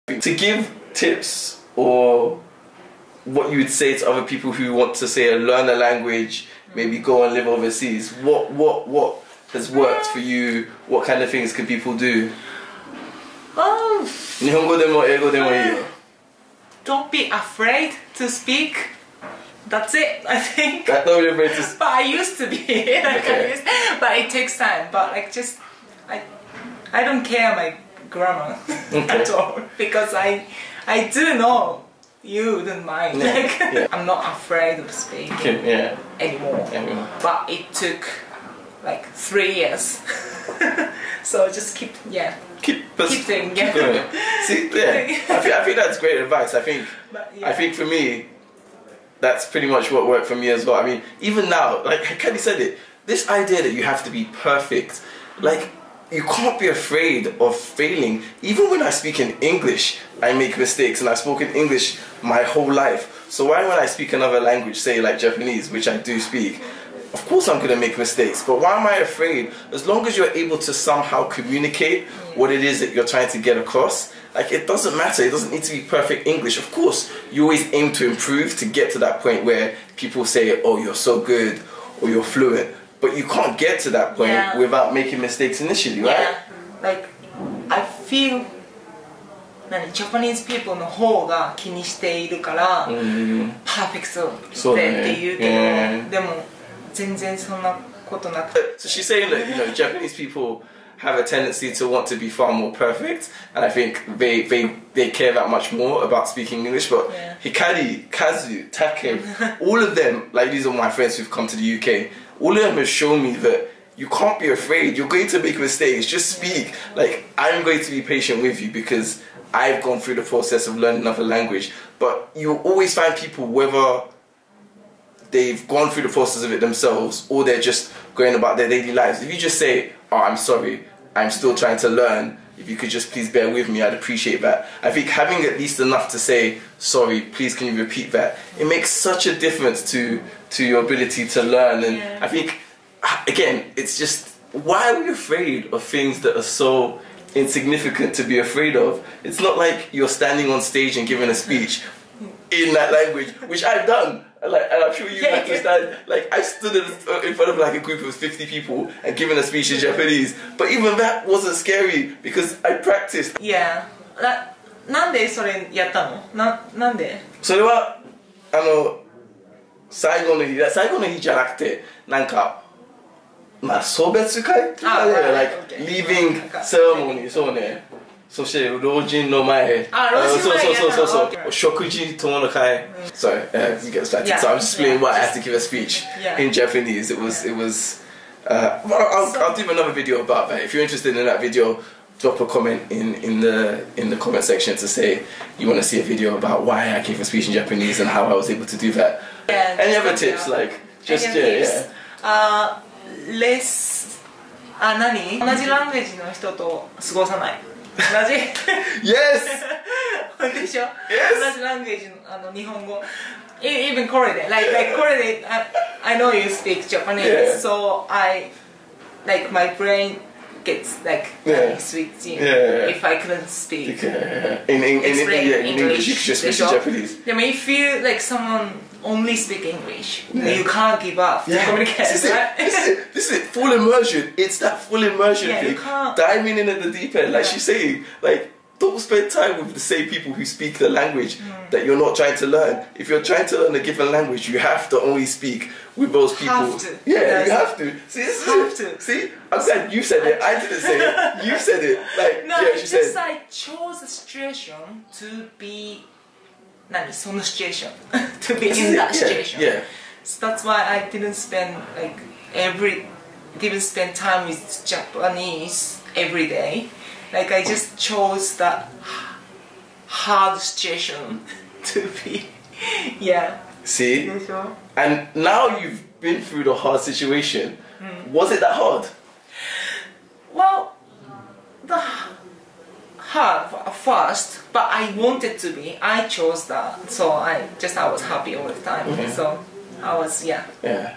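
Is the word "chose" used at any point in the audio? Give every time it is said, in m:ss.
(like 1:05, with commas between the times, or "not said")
4:13, 4:27, 4:46.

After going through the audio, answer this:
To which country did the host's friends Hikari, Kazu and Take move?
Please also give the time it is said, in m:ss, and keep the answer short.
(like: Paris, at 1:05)
UK, at 1:51.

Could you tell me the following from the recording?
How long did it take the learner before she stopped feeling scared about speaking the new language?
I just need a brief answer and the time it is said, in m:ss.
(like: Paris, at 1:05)
3 years, at 0:39.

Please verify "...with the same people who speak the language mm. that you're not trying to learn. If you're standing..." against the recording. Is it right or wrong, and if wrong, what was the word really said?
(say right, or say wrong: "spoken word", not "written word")
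wrong: "trying", not "standing".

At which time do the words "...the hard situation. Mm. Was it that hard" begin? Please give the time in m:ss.
4:36.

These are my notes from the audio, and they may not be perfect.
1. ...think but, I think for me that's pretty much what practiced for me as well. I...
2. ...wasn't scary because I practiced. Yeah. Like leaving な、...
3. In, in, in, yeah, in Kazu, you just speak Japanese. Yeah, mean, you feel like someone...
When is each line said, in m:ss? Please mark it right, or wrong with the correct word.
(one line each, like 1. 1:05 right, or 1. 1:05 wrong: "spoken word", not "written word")
1. 0:46 wrong: "worked", not "practiced"
2. 2:41 right
3. 3:44 wrong: "English", not "Kazu".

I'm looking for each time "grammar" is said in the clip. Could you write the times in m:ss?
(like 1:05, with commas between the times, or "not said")
0:28.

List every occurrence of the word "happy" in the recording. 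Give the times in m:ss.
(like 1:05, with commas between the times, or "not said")
4:48.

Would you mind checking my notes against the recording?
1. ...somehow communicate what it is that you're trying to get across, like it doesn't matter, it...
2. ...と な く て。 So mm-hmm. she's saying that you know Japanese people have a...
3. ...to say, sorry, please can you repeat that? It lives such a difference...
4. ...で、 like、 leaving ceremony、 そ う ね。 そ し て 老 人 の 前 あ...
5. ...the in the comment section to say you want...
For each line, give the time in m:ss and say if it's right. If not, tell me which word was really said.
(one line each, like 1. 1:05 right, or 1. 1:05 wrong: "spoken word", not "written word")
1. 1:10 right
2. 1:38 right
3. 2:16 wrong: "makes", not "lives"
4. 2:55 right
5. 3:13 right.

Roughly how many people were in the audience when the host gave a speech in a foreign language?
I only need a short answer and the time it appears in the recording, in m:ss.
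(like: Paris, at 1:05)
50, at 2:38.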